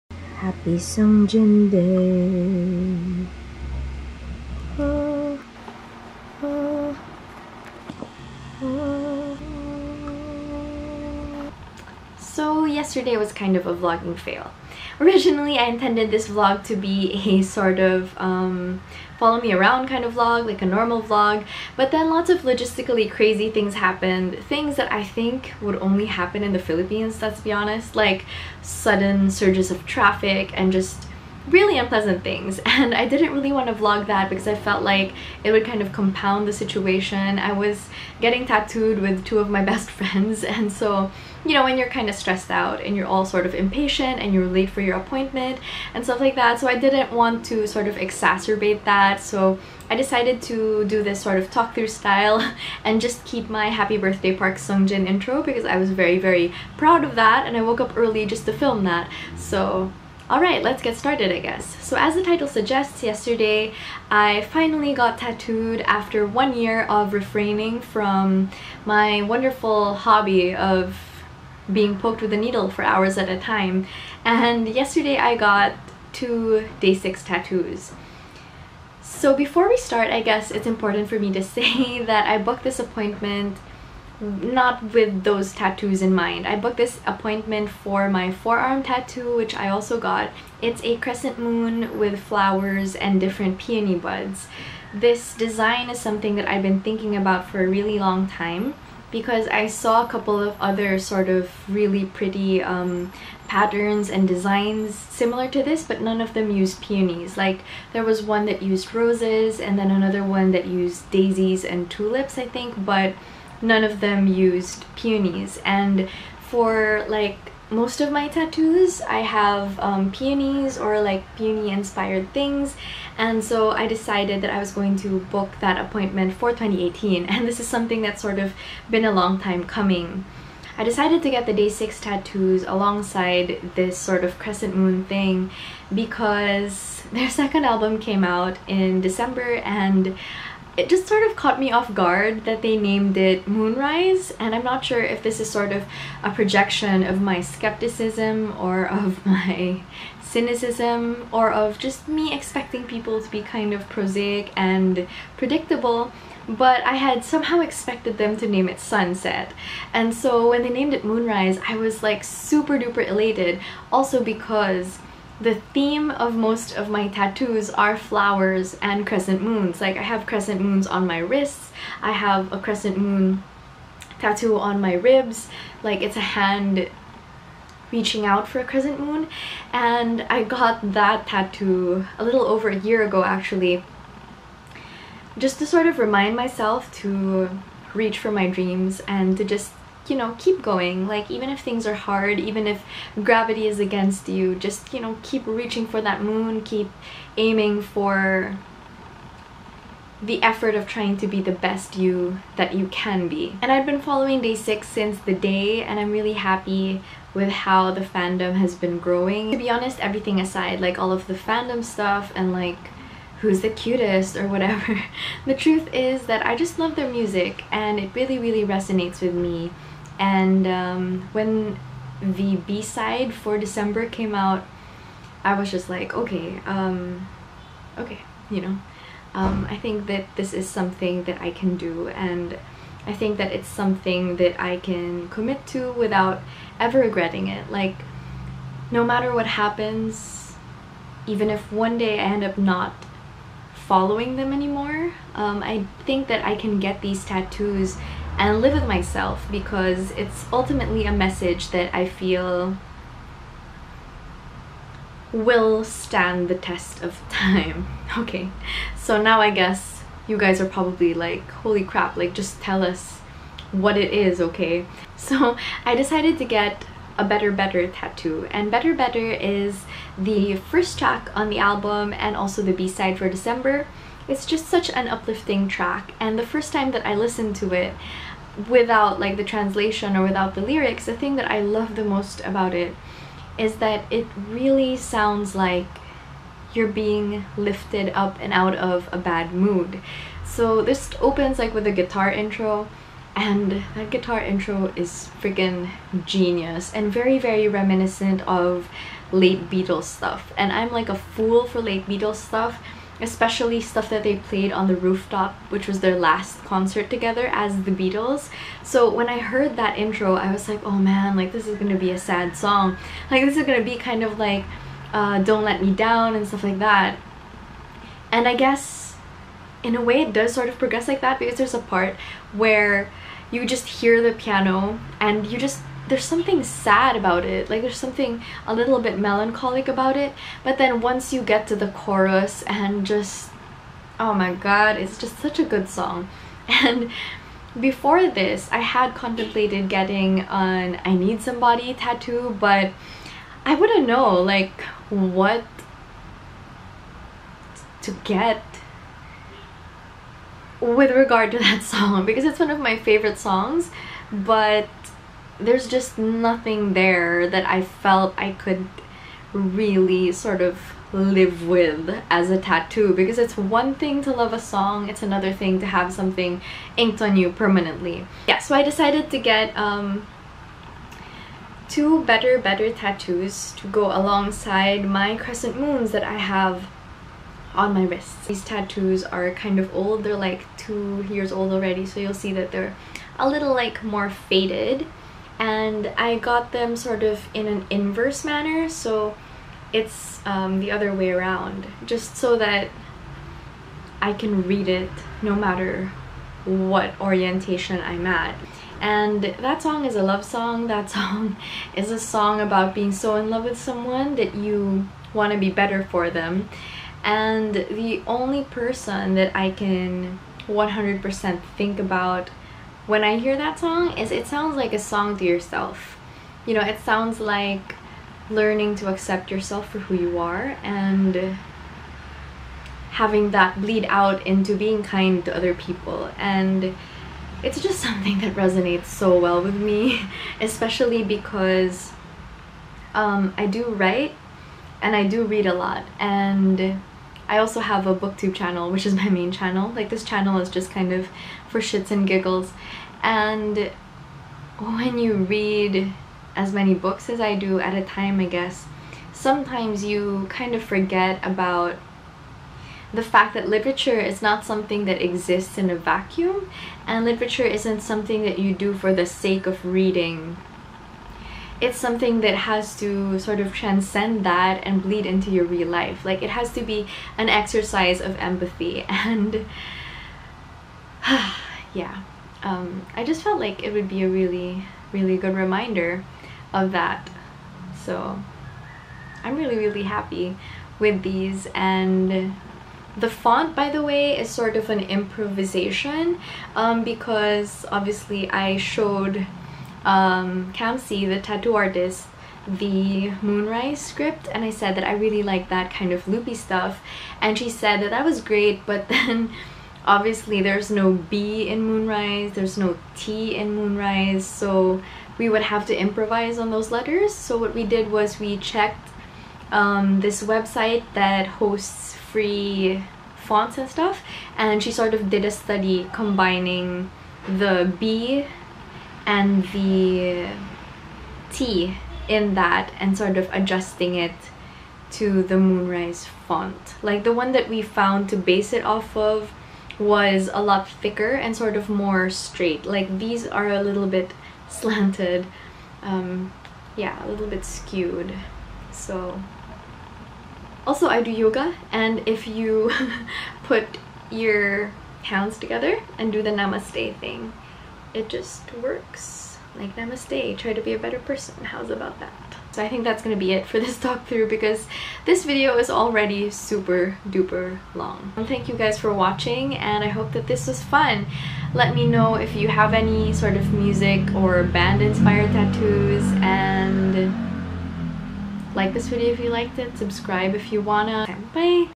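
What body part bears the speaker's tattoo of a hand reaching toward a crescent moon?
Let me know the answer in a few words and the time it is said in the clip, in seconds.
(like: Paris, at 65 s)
Ribs, at 174 s.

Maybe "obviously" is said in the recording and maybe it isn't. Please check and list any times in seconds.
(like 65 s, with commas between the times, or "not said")
487 s, 500 s.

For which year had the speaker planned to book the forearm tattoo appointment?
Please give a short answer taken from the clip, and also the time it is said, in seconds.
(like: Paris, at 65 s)
2018, at 126 s.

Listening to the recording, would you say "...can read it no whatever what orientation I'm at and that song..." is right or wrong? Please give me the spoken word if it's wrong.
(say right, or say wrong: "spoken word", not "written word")
wrong: "matter", not "whatever".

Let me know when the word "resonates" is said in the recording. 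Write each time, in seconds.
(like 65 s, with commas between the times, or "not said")
218 s, 428 s.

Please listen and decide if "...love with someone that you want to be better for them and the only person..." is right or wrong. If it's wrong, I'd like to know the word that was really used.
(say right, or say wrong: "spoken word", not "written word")
right.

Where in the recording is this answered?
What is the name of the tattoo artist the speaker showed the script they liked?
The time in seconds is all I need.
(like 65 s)
490 s.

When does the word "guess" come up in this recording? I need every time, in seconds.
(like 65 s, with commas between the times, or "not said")
61 s, 80 s, 259 s, 318 s, 448 s.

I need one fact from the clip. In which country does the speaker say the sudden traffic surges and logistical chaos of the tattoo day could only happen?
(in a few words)
Philippines.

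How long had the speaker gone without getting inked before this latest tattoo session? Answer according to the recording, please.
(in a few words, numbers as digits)
1 year.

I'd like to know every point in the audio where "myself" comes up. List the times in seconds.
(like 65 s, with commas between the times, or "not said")
186 s, 248 s.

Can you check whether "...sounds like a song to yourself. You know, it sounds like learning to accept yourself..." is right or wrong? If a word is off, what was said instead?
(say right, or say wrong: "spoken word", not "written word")
right.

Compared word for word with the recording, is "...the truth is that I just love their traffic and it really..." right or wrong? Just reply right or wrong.
wrong.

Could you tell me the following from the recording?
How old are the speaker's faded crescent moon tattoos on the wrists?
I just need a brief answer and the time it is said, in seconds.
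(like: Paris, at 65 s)
2 years, at 380 s.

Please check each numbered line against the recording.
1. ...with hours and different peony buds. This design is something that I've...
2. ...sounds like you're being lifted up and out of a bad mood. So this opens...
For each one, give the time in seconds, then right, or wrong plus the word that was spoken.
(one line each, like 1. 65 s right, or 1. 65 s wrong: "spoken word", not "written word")
1. 91 s wrong: "flowers", not "hours"
2. 284 s right.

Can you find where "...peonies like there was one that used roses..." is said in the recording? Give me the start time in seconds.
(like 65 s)
106 s.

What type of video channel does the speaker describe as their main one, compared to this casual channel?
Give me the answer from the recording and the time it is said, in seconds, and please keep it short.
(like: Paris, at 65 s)
Booktube channel, at 438 s.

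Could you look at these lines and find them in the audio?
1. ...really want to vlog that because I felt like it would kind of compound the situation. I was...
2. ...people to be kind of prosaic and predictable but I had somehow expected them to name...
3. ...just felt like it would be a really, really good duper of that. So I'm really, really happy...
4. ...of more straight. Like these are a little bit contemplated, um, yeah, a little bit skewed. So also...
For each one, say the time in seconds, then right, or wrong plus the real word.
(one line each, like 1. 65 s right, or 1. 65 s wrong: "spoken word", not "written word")
1. 33 s right
2. 152 s right
3. 473 s wrong: "reminder", not "duper"
4. 531 s wrong: "slanted", not "contemplated".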